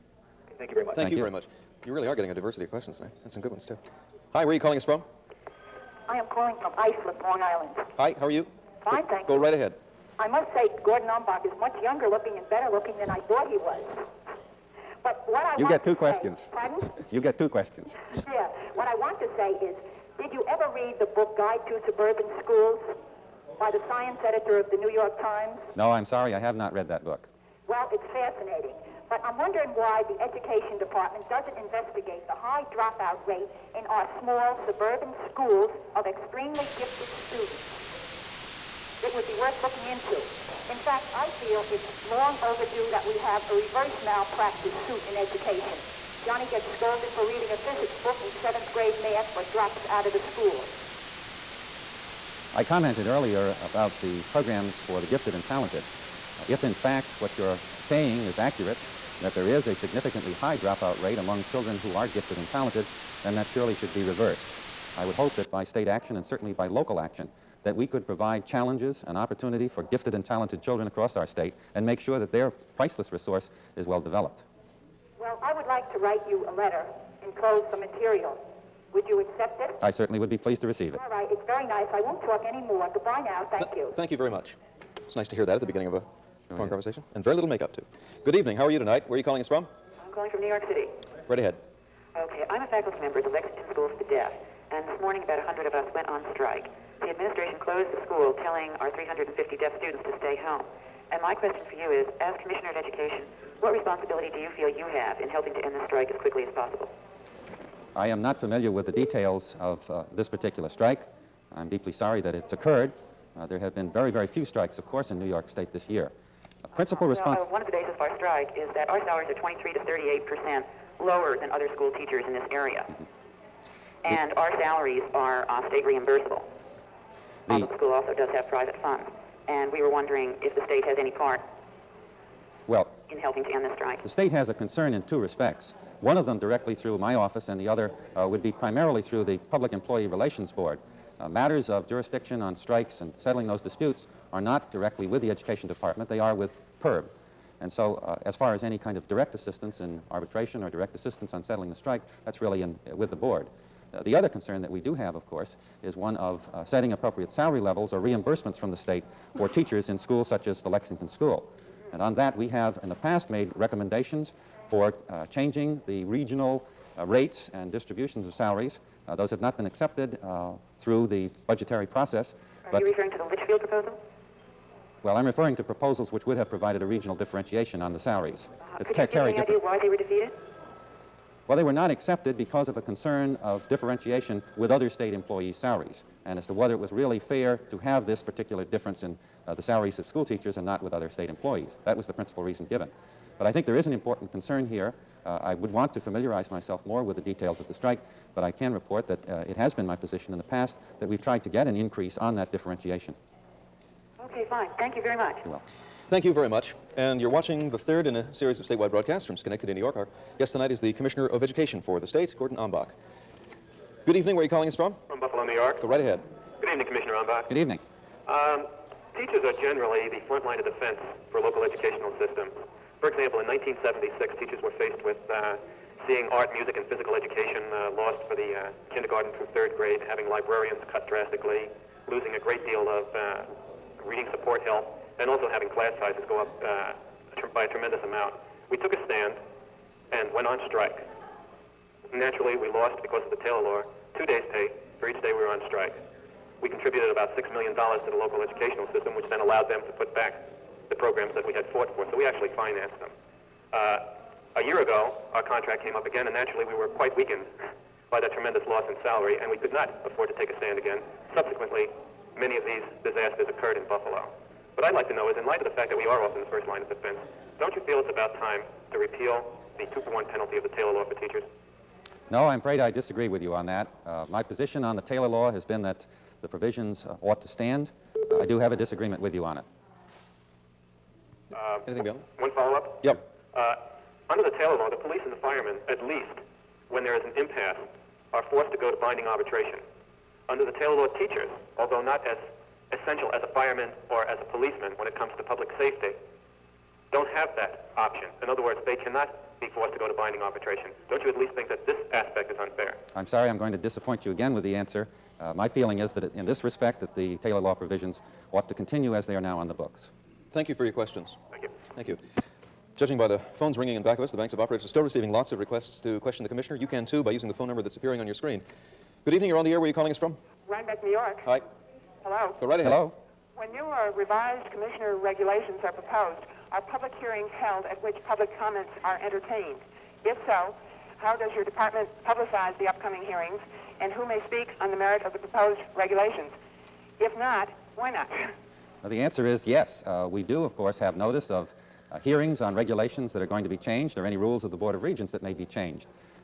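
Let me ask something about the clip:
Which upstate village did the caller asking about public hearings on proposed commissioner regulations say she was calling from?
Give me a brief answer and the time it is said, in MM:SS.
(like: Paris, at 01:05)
Rhinebeck, at 05:20.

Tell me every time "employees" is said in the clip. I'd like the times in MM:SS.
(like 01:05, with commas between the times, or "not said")
02:19, 03:05, 03:11.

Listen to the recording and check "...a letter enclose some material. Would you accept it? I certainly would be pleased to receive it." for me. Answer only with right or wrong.
right.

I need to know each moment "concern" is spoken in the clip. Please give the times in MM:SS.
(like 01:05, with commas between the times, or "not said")
02:14, 02:34, 03:02, 03:14.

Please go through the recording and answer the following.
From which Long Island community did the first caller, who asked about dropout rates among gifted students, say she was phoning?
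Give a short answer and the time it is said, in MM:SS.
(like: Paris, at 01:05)
Islip, at 00:06.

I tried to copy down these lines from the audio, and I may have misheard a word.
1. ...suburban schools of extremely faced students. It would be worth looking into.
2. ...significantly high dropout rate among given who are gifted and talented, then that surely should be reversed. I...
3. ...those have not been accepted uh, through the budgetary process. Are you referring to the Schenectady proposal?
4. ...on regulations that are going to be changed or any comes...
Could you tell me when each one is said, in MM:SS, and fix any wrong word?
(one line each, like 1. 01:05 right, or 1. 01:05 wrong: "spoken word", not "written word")
1. 00:34 wrong: "gifted", not "faced"
2. 00:59 wrong: "children", not "given"
3. 02:49 wrong: "Litchfield", not "Schenectady"
4. 05:42 wrong: "rules", not "comes".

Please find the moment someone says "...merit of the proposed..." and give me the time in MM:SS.
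05:34.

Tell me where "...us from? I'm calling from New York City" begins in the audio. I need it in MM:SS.
01:29.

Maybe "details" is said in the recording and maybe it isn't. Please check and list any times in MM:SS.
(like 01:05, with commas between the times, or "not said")
01:48, 03:17.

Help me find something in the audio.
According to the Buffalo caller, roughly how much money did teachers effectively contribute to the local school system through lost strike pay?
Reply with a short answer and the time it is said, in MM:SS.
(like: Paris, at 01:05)
$6 million, at 04:07.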